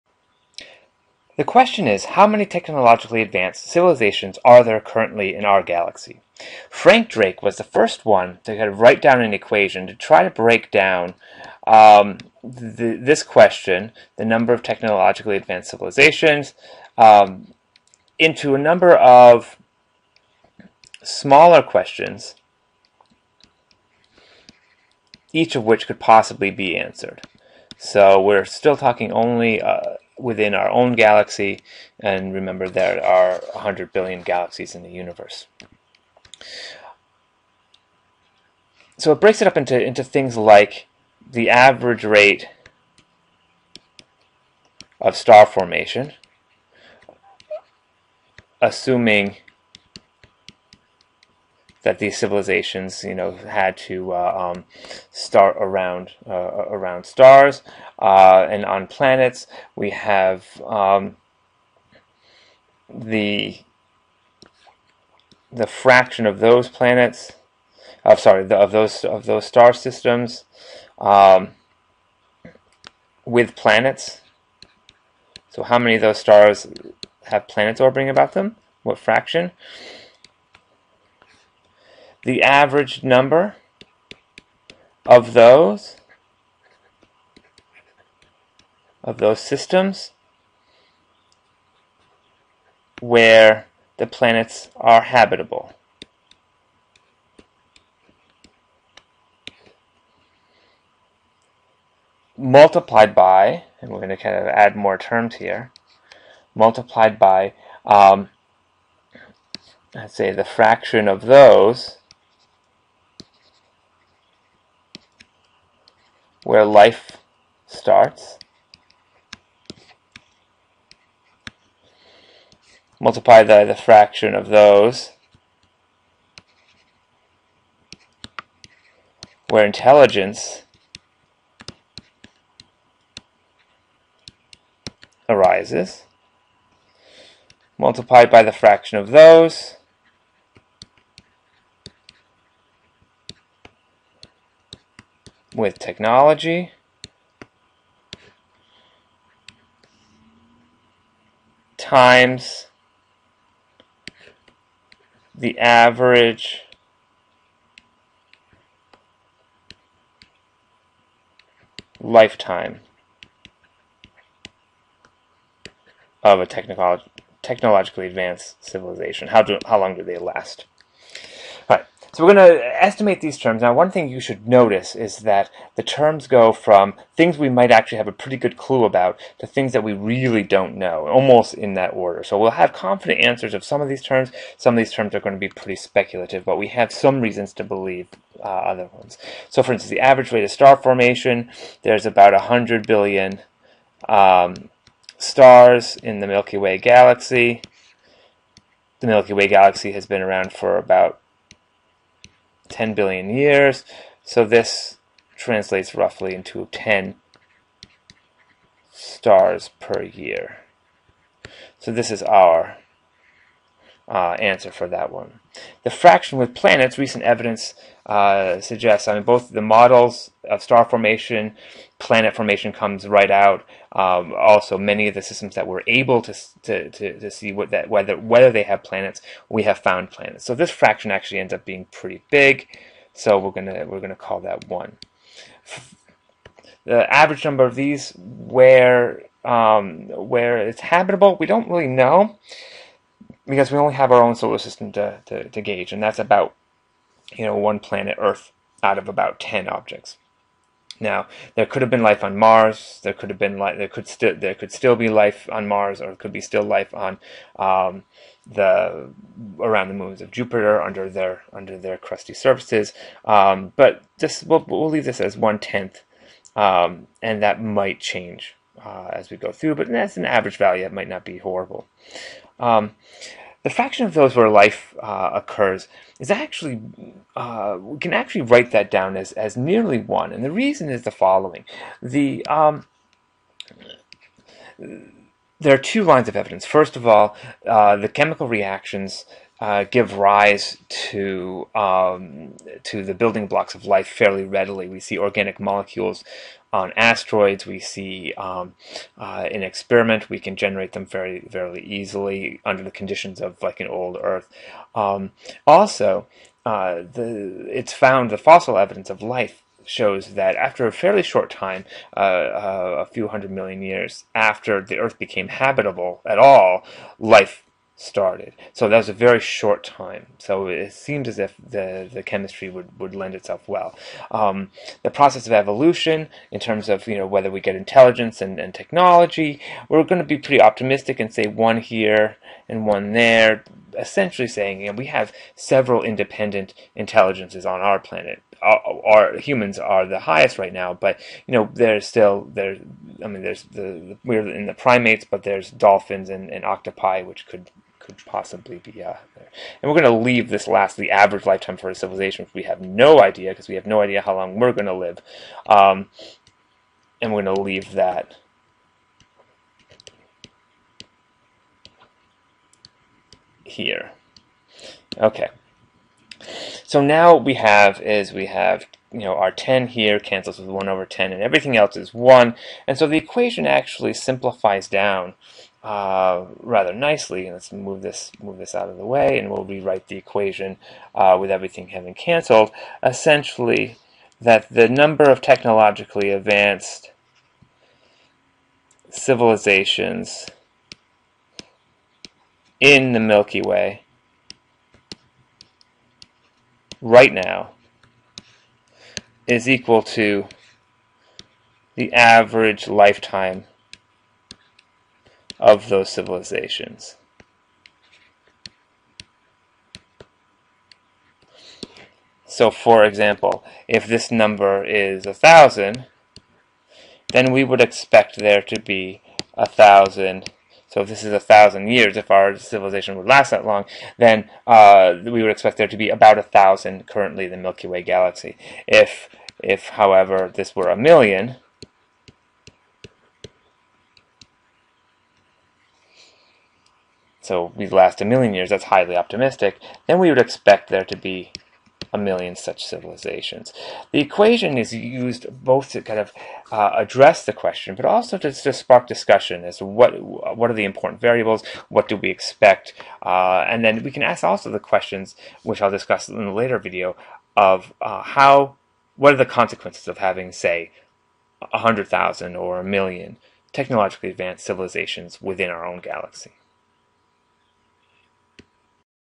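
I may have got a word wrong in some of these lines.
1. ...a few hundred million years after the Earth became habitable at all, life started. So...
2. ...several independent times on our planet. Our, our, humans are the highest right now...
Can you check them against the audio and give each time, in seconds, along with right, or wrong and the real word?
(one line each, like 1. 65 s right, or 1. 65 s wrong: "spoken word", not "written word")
1. 312 s right
2. 335 s wrong: "intelligences", not "times".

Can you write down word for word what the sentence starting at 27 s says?
So we're still talking only uh, within our own galaxy, and remember there are 100 billion galaxies in the universe.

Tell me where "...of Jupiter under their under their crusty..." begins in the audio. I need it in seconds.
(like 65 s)
260 s.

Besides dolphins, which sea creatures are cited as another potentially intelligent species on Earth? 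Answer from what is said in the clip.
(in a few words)
octopi.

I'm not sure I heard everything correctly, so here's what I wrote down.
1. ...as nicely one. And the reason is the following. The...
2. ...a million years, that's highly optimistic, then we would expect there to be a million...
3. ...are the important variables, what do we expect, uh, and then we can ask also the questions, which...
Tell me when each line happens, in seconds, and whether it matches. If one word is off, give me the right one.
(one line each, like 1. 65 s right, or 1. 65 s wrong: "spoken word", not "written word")
1. 279 s wrong: "nearly", not "nicely"
2. 438 s right
3. 450 s right.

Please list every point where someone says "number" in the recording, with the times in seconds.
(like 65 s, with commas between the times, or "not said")
14 s, 18 s, 83 s, 237 s, 384 s, 414 s.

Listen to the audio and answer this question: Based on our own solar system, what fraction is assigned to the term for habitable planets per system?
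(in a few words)
one tenth.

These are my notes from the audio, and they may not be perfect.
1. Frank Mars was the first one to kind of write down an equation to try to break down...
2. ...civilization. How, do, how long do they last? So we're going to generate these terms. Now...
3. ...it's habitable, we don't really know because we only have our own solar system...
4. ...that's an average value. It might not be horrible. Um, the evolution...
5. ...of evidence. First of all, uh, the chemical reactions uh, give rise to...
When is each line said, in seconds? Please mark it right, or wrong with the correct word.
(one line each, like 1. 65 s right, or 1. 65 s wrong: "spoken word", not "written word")
1. 6 s wrong: "Drake", not "Mars"
2. 168 s wrong: "estimate", not "generate"
3. 240 s right
4. 269 s wrong: "fraction", not "evolution"
5. 286 s right.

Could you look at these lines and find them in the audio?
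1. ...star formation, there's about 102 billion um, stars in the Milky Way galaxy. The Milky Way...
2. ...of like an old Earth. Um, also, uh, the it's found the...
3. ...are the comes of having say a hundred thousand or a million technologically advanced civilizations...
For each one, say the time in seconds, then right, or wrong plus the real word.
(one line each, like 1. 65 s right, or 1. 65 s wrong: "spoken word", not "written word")
1. 190 s wrong: "100", not "102"
2. 303 s right
3. 459 s wrong: "consequences", not "comes".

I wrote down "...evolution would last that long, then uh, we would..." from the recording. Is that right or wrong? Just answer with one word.
wrong.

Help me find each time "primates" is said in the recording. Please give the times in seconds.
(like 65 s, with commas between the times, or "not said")
344 s.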